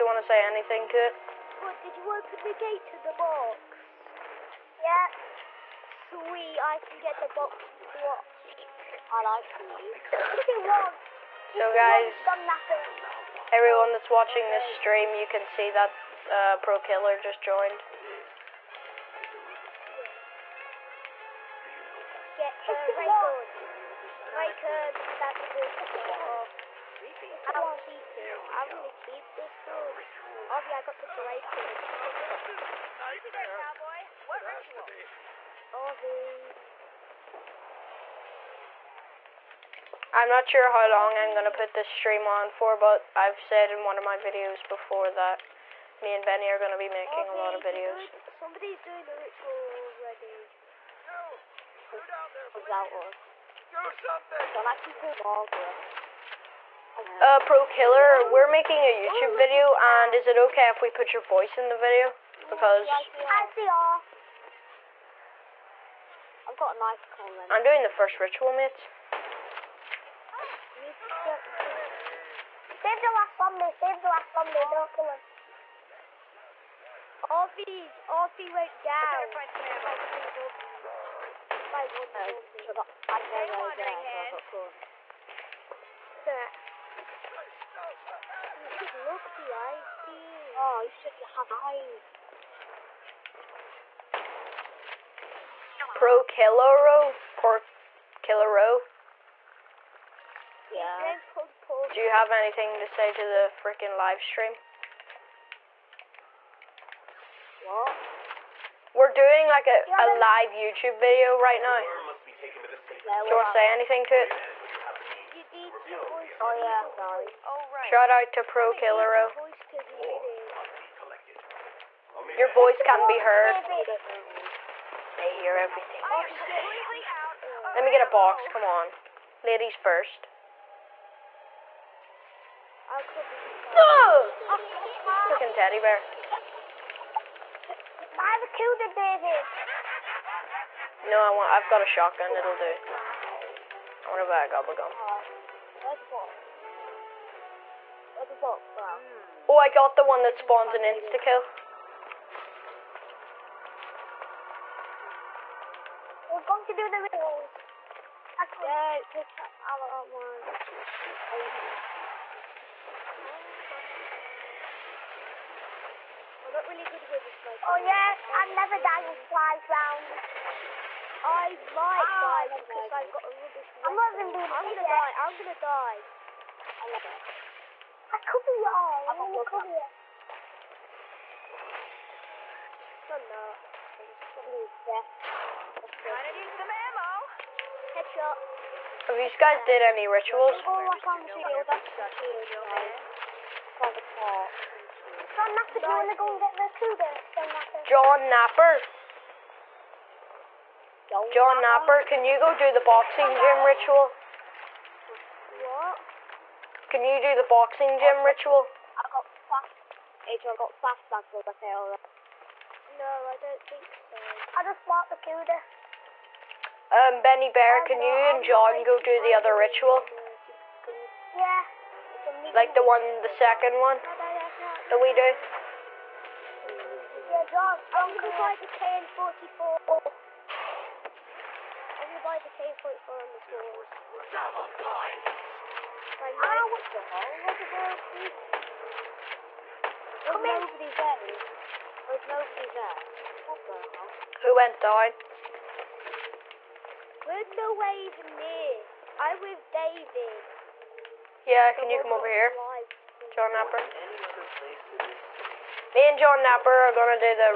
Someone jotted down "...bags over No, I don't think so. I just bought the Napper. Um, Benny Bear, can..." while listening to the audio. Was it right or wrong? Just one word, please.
wrong.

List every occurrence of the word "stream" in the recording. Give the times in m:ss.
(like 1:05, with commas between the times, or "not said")
0:14, 0:41, 1:44.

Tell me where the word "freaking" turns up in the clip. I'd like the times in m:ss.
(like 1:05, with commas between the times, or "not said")
1:43.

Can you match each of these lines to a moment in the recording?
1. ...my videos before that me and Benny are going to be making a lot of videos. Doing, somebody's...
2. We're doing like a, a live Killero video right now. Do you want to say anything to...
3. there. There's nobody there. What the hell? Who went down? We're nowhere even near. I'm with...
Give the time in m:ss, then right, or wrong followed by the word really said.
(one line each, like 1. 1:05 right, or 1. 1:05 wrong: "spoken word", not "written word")
1. 0:44 right
2. 1:48 wrong: "YouTube", not "Killero"
3. 4:00 right.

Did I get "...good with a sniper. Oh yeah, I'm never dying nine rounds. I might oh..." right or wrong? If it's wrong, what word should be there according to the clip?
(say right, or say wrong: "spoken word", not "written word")
wrong: "five", not "nine".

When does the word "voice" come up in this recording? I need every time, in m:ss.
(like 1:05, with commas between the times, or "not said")
1:01, 2:02.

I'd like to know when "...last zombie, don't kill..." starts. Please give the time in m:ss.
1:14.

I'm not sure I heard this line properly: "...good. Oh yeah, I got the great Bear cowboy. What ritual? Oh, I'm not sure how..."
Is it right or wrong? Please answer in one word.
wrong.